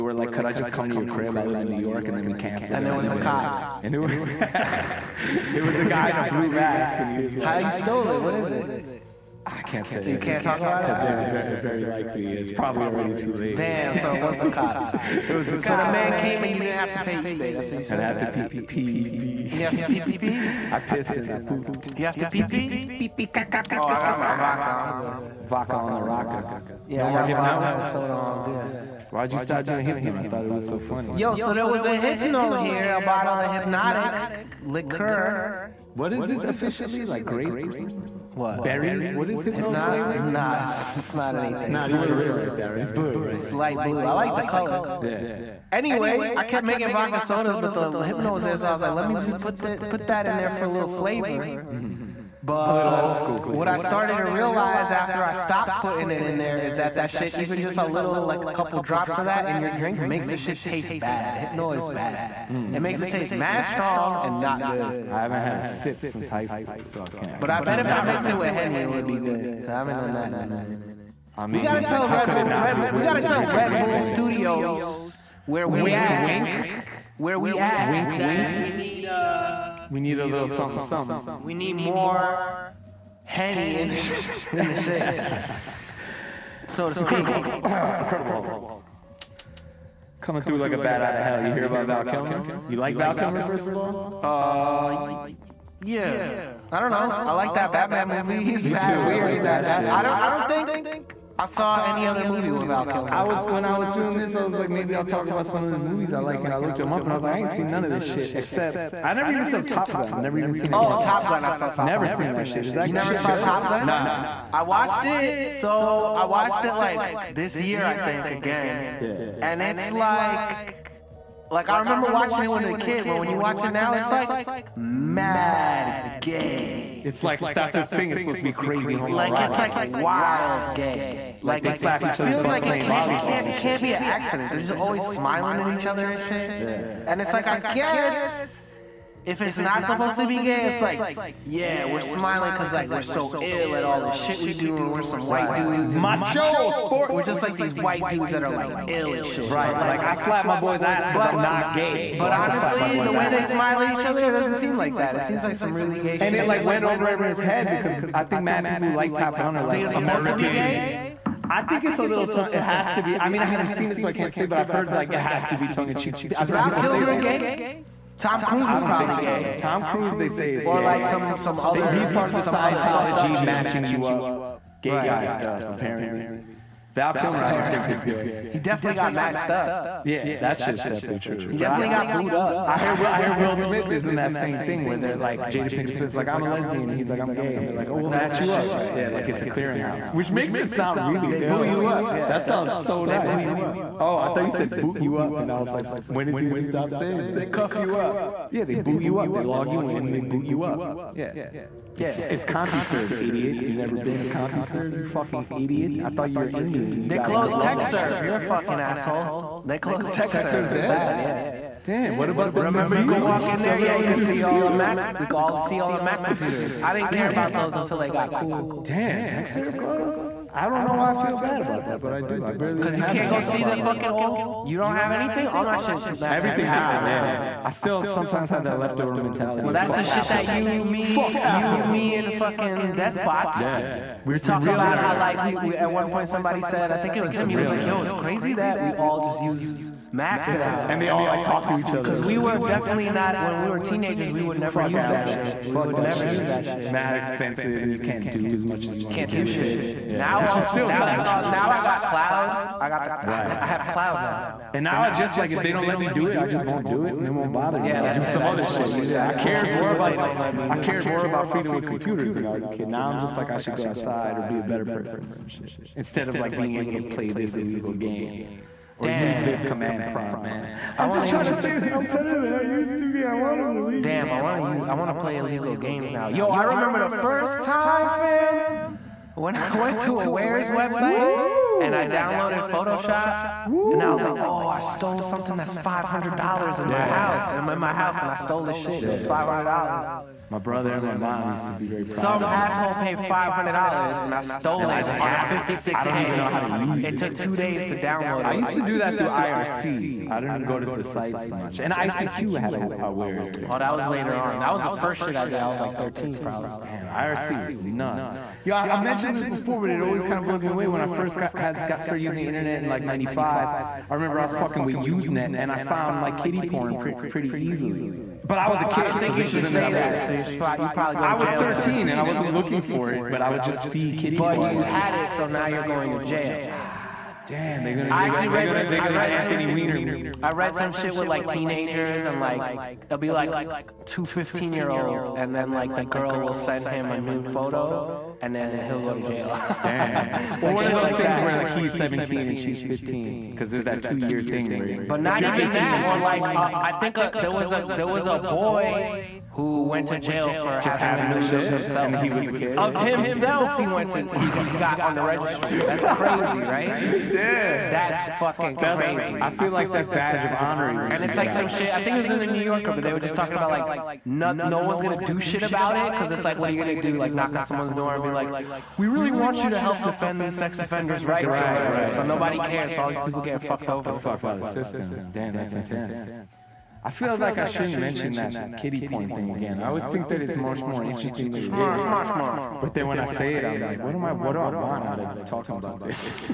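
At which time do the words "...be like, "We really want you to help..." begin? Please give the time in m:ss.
6:08.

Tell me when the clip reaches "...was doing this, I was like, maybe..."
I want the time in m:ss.
1:43.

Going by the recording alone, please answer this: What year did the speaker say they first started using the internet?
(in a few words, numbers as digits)
1995.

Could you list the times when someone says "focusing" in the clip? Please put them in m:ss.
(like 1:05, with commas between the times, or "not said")
not said.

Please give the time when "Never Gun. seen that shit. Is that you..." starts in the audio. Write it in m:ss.
1:51.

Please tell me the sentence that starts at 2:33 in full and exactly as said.
they smile at each other, it doesn't seem like that.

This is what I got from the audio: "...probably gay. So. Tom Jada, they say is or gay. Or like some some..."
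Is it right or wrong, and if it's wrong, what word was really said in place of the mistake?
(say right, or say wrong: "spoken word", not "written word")
wrong: "Cruise", not "Jada".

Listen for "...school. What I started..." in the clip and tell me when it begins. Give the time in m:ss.
0:53.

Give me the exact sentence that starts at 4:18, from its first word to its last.
Yeah, I, I cared more about they don't let me.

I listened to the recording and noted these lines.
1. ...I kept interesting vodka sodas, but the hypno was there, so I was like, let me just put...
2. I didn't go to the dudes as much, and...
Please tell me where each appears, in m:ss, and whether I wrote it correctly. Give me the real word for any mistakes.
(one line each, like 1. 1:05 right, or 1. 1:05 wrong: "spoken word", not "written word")
1. 0:46 wrong: "making", not "interesting"
2. 5:00 wrong: "sites", not "dudes".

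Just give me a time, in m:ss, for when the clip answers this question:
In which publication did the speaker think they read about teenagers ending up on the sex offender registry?
6:02.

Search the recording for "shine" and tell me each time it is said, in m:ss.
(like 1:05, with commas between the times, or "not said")
not said.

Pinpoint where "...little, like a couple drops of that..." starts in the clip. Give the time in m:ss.
0:57.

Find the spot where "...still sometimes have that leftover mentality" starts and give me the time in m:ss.
3:47.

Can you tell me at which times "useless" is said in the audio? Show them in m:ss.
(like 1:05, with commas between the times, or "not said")
not said.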